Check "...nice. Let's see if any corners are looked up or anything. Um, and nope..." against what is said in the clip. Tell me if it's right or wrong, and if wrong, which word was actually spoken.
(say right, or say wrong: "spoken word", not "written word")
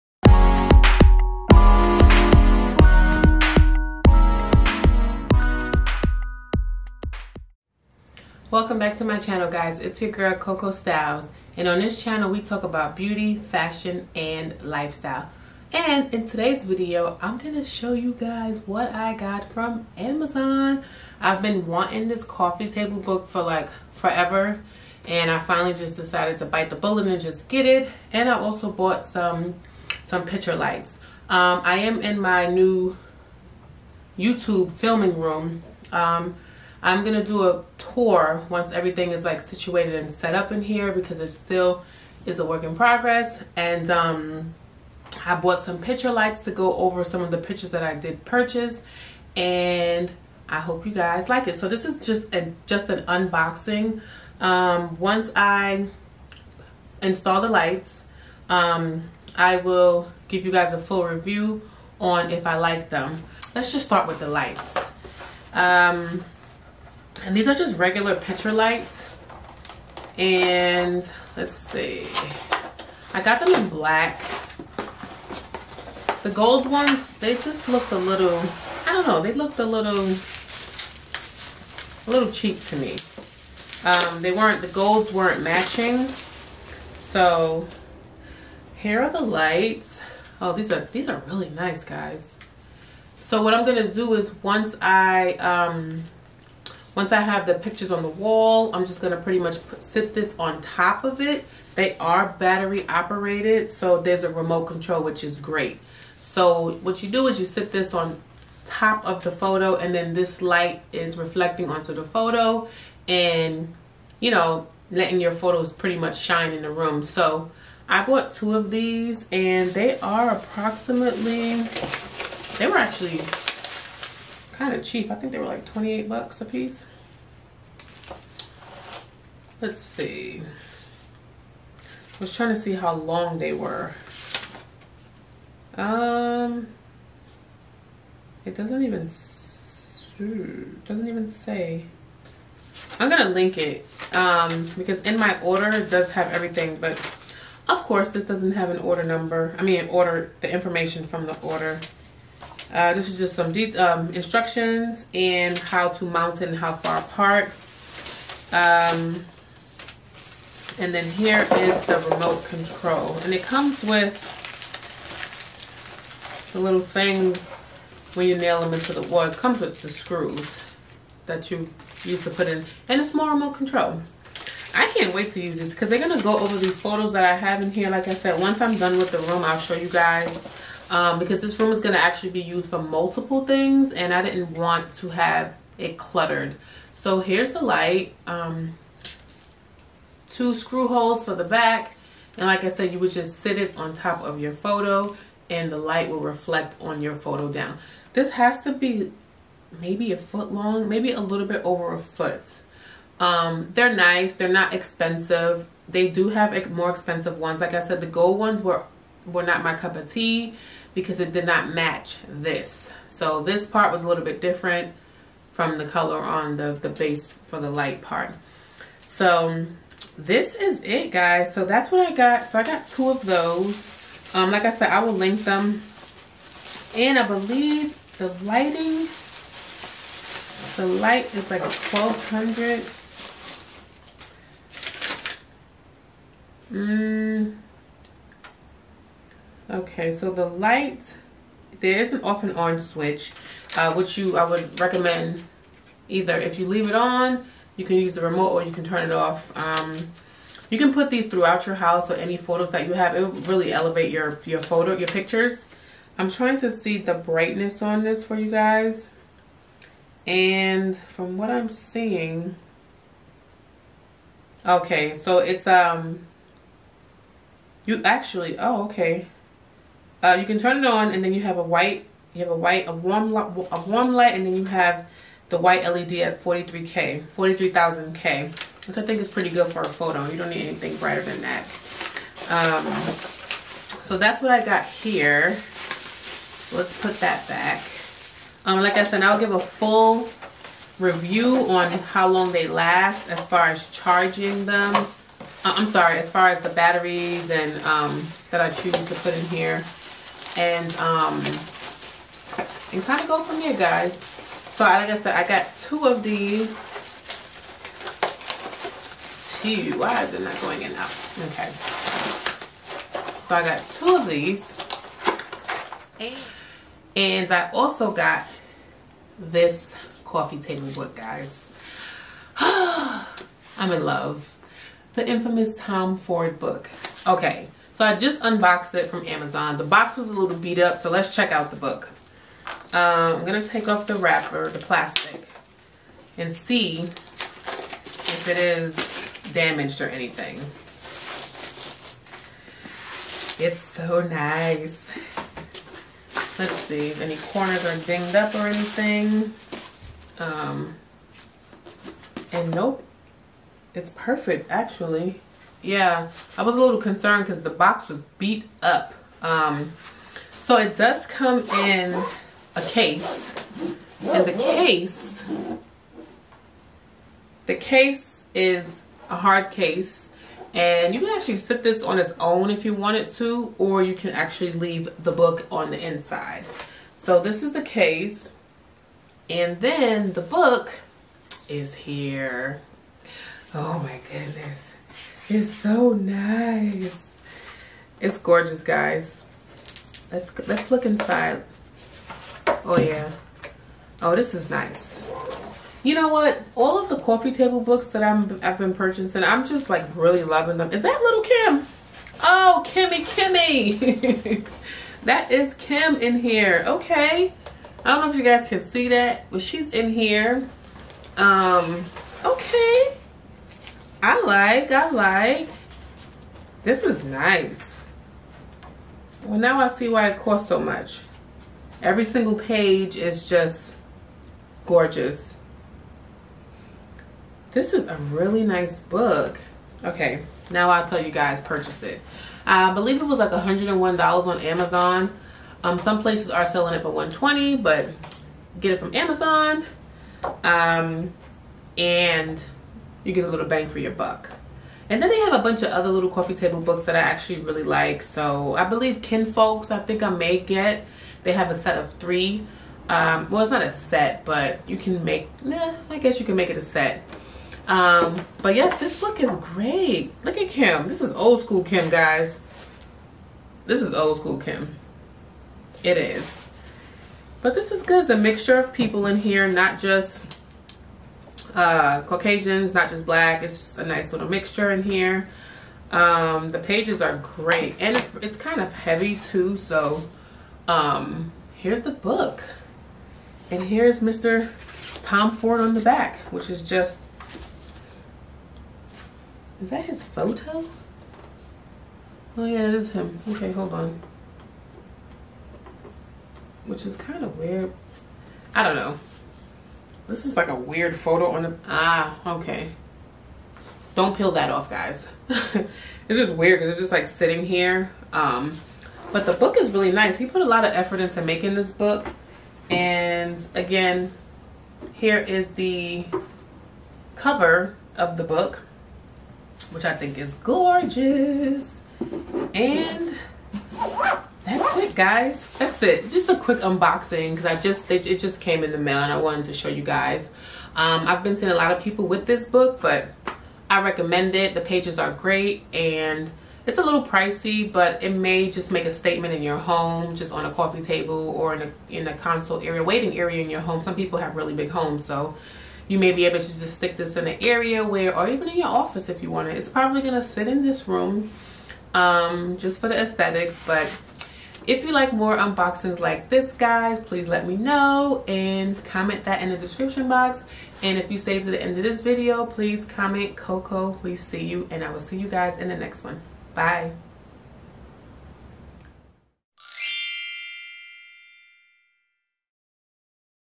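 wrong: "dinged", not "looked".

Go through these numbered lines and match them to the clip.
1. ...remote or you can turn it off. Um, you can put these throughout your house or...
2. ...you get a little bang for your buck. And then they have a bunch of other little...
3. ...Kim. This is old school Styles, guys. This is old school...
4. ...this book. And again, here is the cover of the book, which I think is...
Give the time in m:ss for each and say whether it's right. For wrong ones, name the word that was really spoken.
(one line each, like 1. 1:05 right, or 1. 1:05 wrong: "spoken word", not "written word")
1. 4:08 right
2. 7:23 right
3. 7:40 wrong: "Kim", not "Styles"
4. 8:31 right.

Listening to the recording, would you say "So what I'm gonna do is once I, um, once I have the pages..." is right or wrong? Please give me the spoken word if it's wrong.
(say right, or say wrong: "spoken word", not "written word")
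wrong: "pictures", not "pages".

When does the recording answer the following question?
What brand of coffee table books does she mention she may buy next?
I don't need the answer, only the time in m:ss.
7:29.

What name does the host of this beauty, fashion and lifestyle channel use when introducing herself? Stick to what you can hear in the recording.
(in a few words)
Coco Styles.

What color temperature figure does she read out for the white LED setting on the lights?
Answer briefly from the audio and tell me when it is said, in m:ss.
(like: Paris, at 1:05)
43K, at 4:36.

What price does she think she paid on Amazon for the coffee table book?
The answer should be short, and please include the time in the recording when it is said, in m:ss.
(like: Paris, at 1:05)
$101, at 7:13.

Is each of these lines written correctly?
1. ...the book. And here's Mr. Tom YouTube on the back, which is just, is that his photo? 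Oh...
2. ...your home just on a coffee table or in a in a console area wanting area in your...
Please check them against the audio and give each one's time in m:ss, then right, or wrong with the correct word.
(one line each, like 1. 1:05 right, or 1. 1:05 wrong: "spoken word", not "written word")
1. 8:02 wrong: "Ford", not "YouTube"
2. 8:59 wrong: "waiting", not "wanting".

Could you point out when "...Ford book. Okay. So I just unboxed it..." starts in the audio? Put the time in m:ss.
5:26.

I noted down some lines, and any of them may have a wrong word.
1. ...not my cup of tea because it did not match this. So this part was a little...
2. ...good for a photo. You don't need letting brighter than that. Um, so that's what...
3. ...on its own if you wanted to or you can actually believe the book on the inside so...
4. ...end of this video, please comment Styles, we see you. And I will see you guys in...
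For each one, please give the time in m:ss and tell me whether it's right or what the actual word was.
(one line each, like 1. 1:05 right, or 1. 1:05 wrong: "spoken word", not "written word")
1. 3:29 right
2. 4:39 wrong: "anything", not "letting"
3. 6:12 wrong: "leave", not "believe"
4. 9:21 wrong: "Coco", not "Styles".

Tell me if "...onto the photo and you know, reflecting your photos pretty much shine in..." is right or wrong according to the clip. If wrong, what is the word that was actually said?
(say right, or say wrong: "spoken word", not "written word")
wrong: "letting", not "reflecting".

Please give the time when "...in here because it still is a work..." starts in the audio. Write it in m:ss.
0:40.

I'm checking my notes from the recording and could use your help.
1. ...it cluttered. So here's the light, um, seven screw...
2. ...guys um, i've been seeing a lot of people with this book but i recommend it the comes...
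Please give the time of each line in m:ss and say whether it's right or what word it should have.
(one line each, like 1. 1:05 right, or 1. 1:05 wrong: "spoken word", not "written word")
1. 3:05 wrong: "two", not "seven"
2. 8:50 wrong: "pages", not "comes".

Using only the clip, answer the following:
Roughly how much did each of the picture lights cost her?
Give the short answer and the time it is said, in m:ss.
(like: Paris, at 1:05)
$28, at 2:05.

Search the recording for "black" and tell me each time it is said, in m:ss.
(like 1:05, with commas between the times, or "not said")
1:13, 7:53.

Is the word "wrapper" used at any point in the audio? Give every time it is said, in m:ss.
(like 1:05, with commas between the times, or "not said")
5:34.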